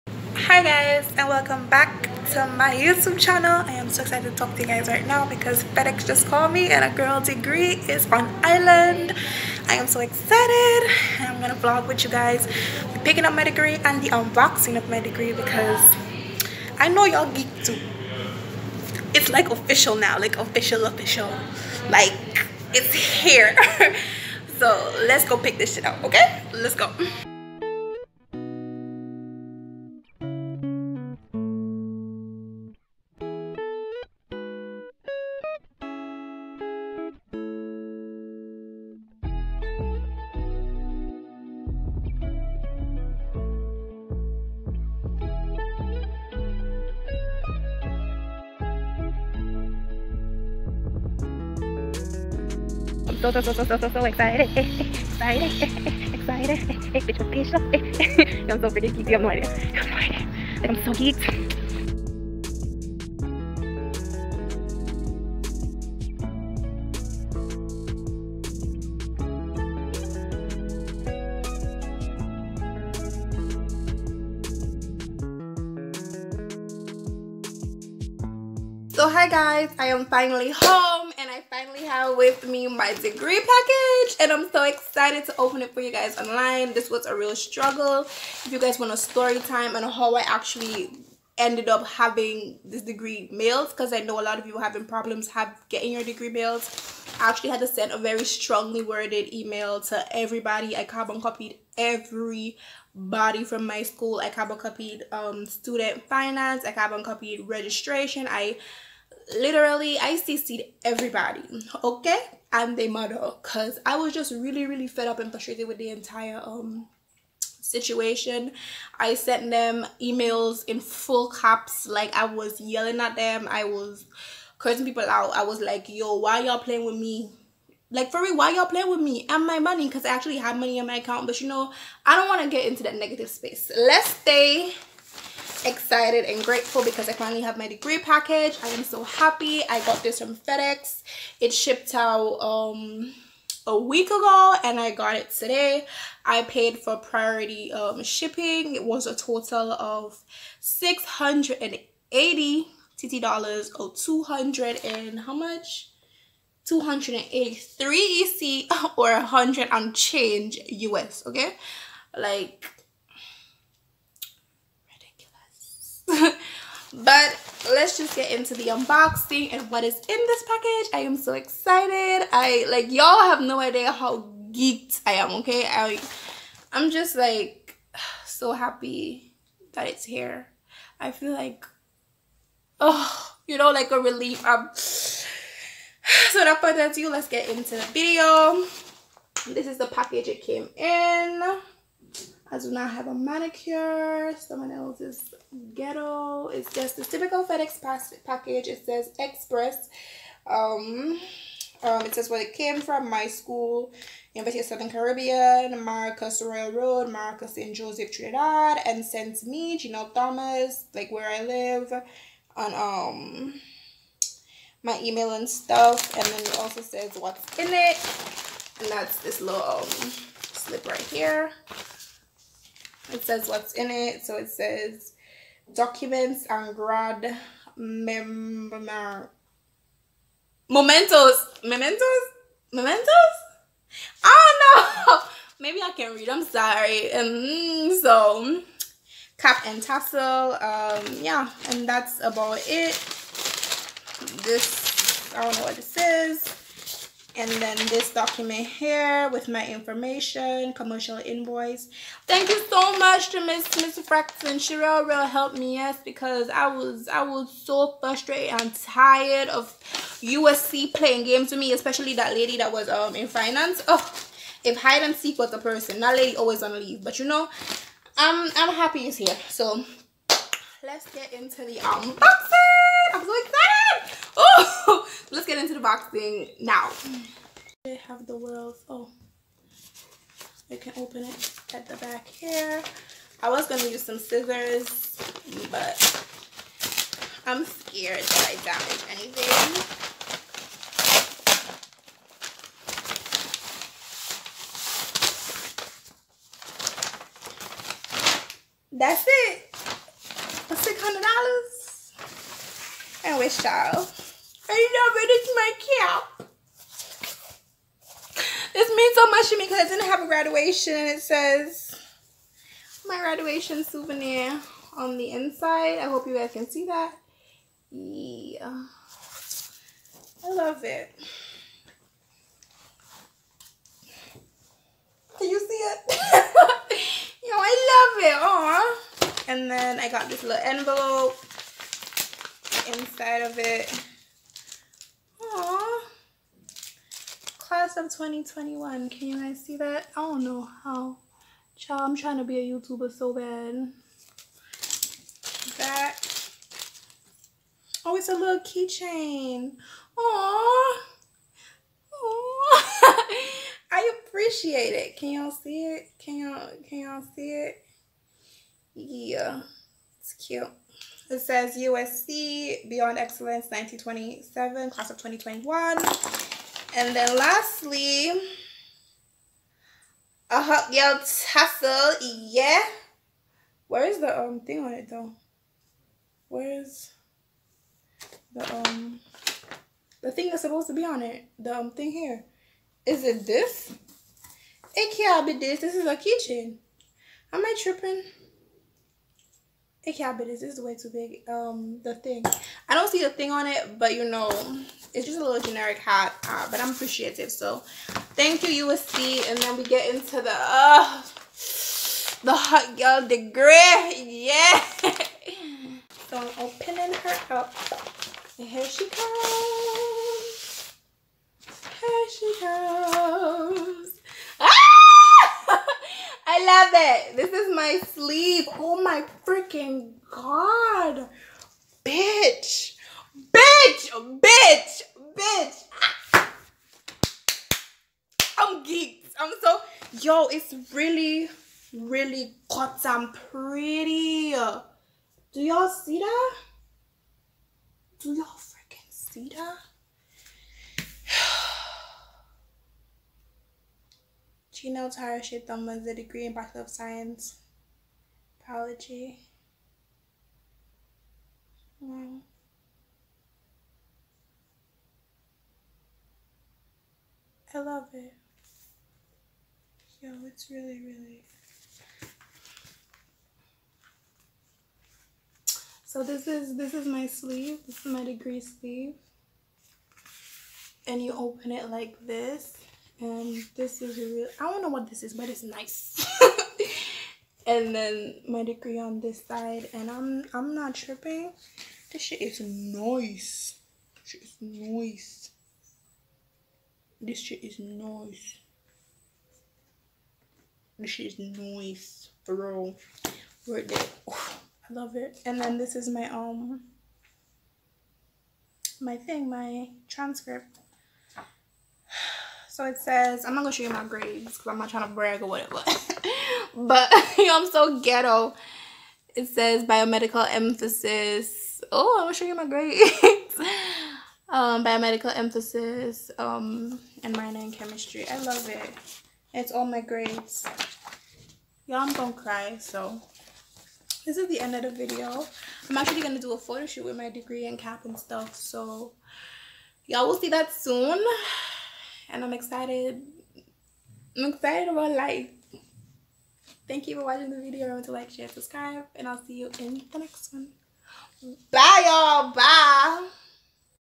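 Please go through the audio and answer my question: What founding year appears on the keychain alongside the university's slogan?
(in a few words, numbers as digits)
1927.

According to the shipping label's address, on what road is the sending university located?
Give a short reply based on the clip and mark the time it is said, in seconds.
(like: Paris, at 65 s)
Maracas Royal Road, at 205 s.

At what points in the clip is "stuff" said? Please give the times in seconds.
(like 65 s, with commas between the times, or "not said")
215 s, 528 s.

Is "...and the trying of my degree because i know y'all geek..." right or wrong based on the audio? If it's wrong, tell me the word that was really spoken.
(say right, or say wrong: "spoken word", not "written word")
wrong: "unboxing", not "trying".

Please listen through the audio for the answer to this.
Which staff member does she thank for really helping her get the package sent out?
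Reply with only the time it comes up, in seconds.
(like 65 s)
253 s.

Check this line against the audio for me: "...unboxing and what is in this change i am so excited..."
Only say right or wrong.
wrong.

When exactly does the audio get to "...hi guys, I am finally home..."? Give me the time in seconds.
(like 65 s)
79 s.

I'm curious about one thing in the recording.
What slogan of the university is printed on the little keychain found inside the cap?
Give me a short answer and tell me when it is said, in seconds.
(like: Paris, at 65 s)
Beyond Excellence, at 362 s.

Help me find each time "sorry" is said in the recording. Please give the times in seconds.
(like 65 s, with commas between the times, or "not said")
236 s.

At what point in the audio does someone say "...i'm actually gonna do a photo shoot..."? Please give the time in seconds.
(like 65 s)
525 s.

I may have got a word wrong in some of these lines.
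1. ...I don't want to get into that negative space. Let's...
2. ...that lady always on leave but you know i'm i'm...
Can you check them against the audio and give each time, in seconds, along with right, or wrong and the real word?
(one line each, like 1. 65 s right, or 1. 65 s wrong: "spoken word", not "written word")
1. 132 s right
2. 266 s right.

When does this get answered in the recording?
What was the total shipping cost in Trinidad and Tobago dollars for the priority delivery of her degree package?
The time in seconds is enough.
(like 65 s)
150 s.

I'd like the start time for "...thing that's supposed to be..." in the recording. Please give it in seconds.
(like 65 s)
380 s.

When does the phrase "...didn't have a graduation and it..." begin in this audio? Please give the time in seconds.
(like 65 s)
309 s.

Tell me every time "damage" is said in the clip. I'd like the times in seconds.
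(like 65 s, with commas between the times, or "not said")
288 s.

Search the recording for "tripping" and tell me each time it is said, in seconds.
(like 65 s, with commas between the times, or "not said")
387 s, 480 s.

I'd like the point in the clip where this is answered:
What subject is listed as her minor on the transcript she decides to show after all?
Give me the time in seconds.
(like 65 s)
517 s.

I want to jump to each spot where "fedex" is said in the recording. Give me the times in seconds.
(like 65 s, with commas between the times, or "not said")
5 s, 140 s, 197 s.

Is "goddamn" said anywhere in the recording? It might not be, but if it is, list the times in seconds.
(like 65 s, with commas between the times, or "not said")
432 s.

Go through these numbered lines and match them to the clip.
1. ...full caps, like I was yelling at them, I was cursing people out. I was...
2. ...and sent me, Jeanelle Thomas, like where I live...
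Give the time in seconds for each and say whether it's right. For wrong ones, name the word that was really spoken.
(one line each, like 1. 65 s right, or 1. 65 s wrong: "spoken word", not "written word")
1. 120 s right
2. 208 s right.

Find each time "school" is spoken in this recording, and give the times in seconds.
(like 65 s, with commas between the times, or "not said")
103 s, 203 s.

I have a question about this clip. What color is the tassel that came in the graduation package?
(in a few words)
Yellow.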